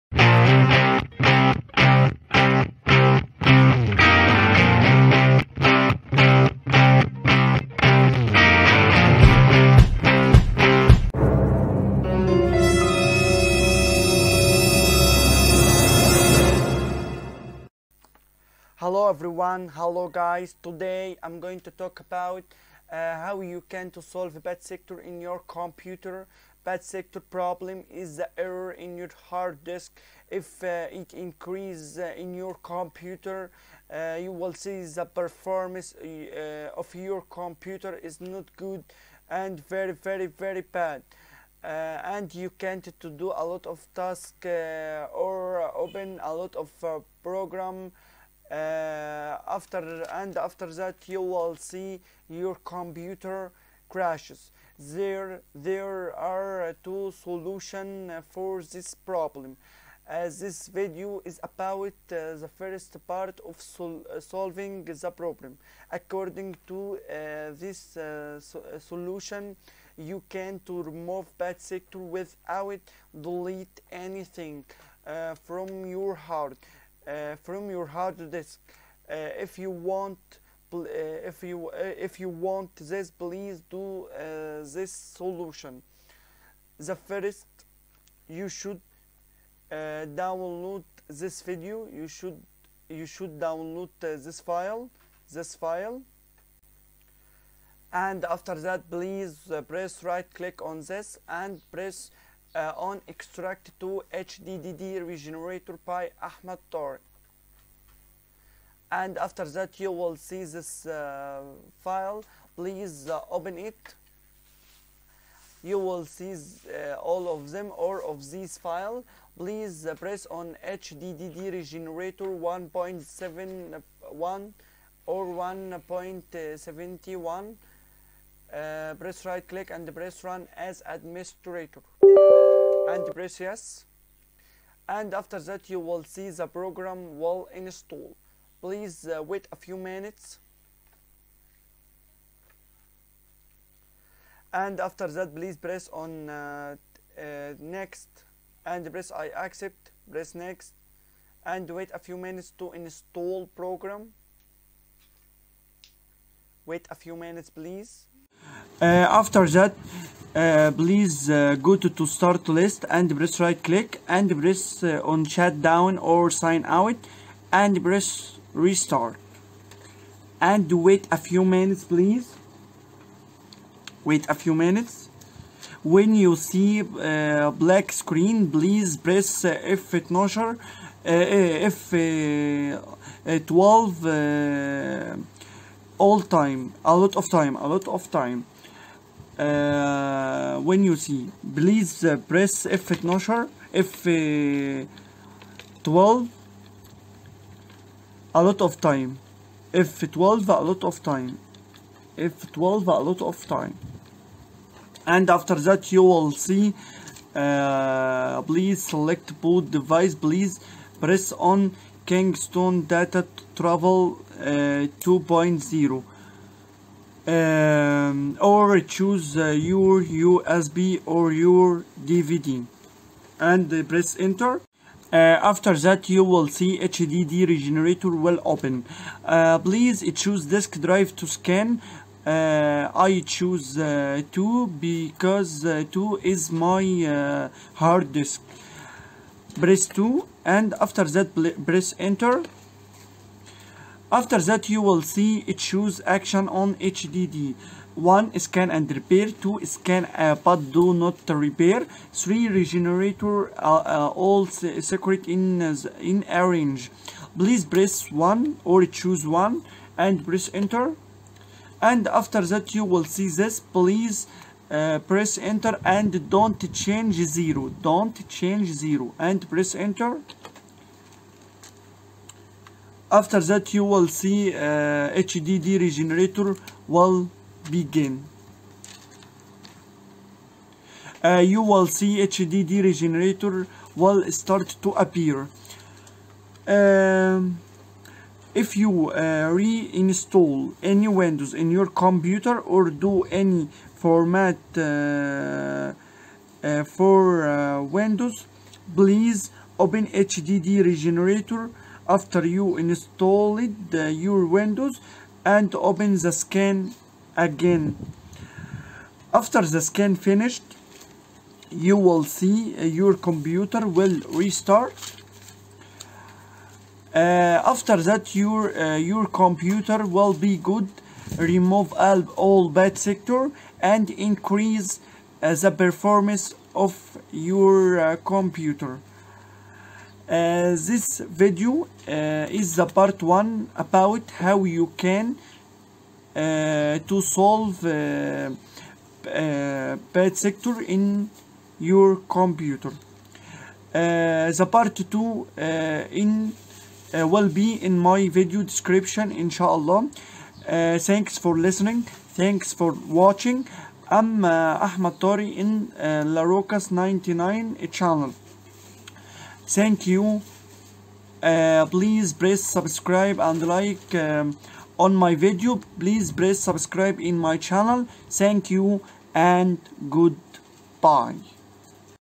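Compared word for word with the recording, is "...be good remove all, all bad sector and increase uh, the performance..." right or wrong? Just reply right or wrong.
right.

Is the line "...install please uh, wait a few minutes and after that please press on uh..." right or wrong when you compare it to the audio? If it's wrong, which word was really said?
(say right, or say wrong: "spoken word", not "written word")
right.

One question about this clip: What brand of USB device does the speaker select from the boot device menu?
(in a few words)
Kingston.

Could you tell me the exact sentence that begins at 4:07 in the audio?
1 scan and repair 2 scan uh, but do not repair 3 regenerator uh, uh, all secret in uh, in arrange.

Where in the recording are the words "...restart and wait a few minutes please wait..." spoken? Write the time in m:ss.
2:48.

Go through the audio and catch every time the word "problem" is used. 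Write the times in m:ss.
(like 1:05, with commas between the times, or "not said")
0:27, 0:58, 1:05.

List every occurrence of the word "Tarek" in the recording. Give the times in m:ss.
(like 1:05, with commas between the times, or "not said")
1:46, 5:55.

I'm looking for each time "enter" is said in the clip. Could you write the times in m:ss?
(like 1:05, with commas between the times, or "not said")
3:44, 4:01, 4:20, 4:25, 4:29.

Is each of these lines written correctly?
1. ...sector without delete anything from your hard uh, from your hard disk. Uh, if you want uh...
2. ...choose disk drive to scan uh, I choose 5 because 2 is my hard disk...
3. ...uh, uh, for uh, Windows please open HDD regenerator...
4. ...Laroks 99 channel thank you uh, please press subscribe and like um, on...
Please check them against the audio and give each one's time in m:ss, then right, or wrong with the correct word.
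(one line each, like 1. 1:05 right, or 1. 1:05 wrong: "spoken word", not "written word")
1. 1:11 right
2. 3:50 wrong: "2", not "5"
3. 4:54 right
4. 5:56 right.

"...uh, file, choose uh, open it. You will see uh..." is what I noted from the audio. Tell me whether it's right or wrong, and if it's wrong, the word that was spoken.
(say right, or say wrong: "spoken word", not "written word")
wrong: "please", not "choose".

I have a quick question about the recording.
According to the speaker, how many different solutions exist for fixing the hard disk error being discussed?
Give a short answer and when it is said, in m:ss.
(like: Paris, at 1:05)
2, at 0:56.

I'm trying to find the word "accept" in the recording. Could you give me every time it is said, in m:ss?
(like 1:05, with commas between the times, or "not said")
2:29.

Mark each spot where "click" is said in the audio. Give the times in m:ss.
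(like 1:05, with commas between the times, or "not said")
1:40, 2:09, 2:43.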